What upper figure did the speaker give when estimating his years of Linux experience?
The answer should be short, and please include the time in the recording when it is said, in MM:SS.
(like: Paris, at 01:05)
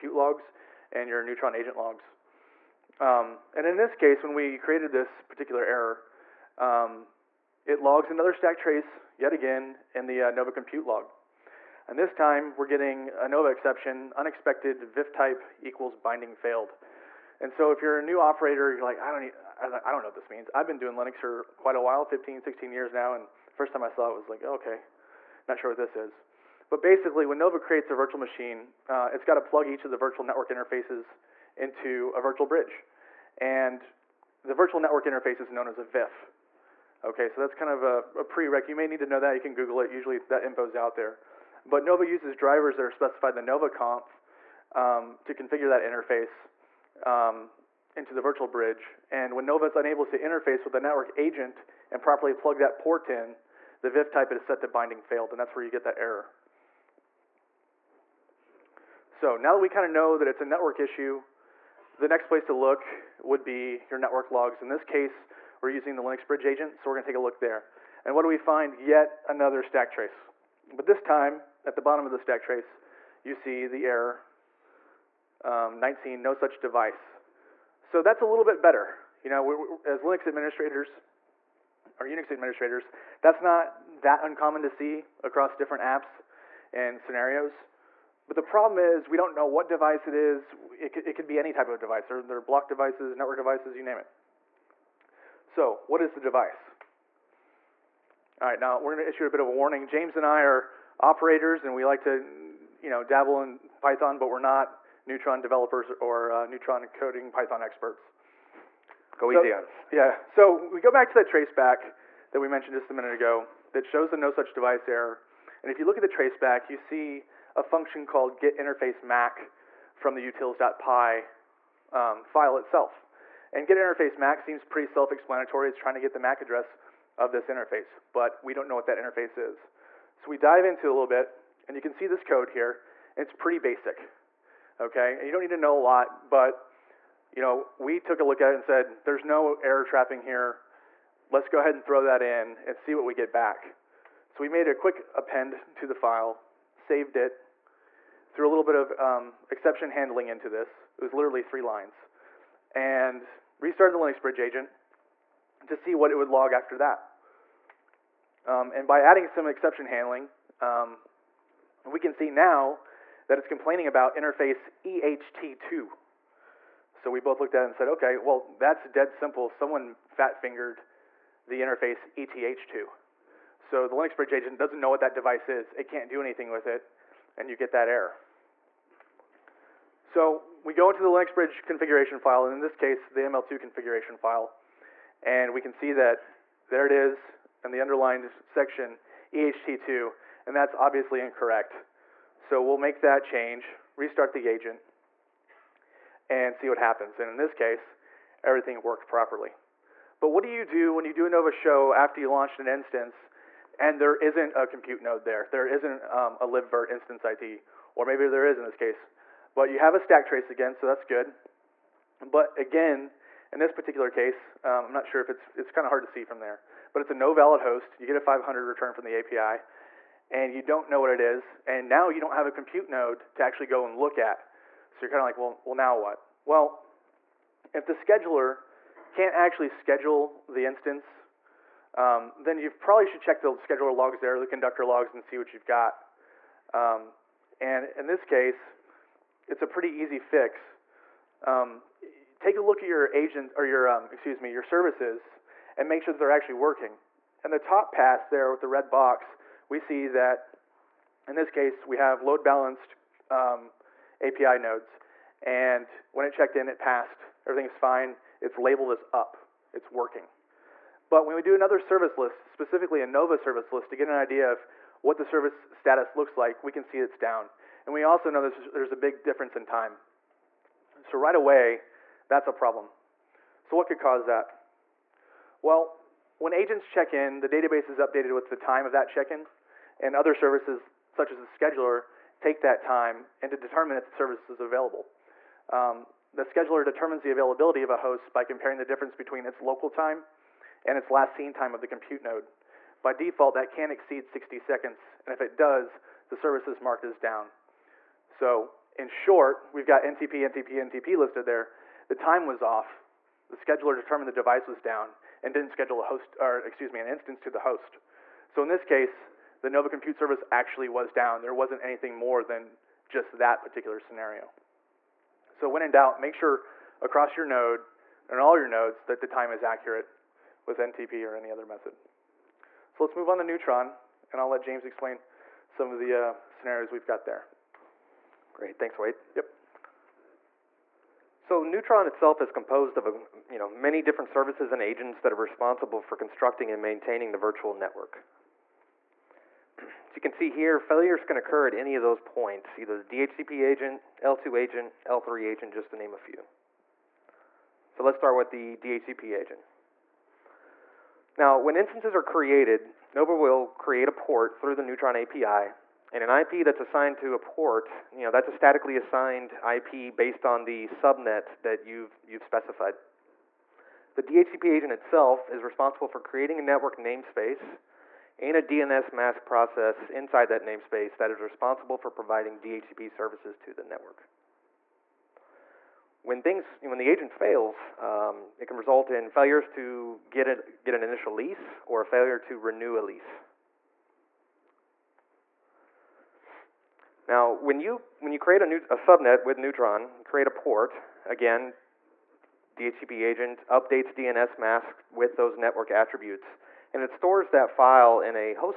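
16, at 00:22.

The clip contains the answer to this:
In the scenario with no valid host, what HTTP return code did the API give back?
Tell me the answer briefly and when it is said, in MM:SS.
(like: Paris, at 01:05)
500, at 03:38.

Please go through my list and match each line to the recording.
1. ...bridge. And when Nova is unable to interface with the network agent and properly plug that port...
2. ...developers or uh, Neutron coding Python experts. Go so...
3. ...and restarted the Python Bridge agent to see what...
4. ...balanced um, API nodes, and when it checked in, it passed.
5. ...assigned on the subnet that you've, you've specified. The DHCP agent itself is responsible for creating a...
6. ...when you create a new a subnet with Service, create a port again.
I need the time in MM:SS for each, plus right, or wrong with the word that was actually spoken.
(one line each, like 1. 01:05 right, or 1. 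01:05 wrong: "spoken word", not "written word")
1. 00:48 right
2. 01:45 right
3. 02:32 wrong: "Linux", not "Python"
4. 04:12 right
5. 06:00 wrong: "based", not "assigned"
6. 06:28 wrong: "Neutron", not "Service".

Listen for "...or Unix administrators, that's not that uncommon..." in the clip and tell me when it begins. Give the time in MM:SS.
01:21.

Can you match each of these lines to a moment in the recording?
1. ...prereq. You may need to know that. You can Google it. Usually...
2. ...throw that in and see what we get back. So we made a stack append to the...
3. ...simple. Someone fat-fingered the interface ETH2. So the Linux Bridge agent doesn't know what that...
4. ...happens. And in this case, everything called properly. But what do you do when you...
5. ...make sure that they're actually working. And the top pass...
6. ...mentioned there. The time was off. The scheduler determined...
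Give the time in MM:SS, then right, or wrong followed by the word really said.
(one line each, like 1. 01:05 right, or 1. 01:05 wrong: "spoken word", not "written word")
1. 00:38 right
2. 02:21 wrong: "quick", not "stack"
3. 02:49 right
4. 03:16 wrong: "worked", not "called"
5. 04:05 right
6. 05:01 wrong: "listed", not "mentioned".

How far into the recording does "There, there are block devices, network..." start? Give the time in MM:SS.
01:32.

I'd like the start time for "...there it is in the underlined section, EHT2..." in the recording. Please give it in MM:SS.
03:06.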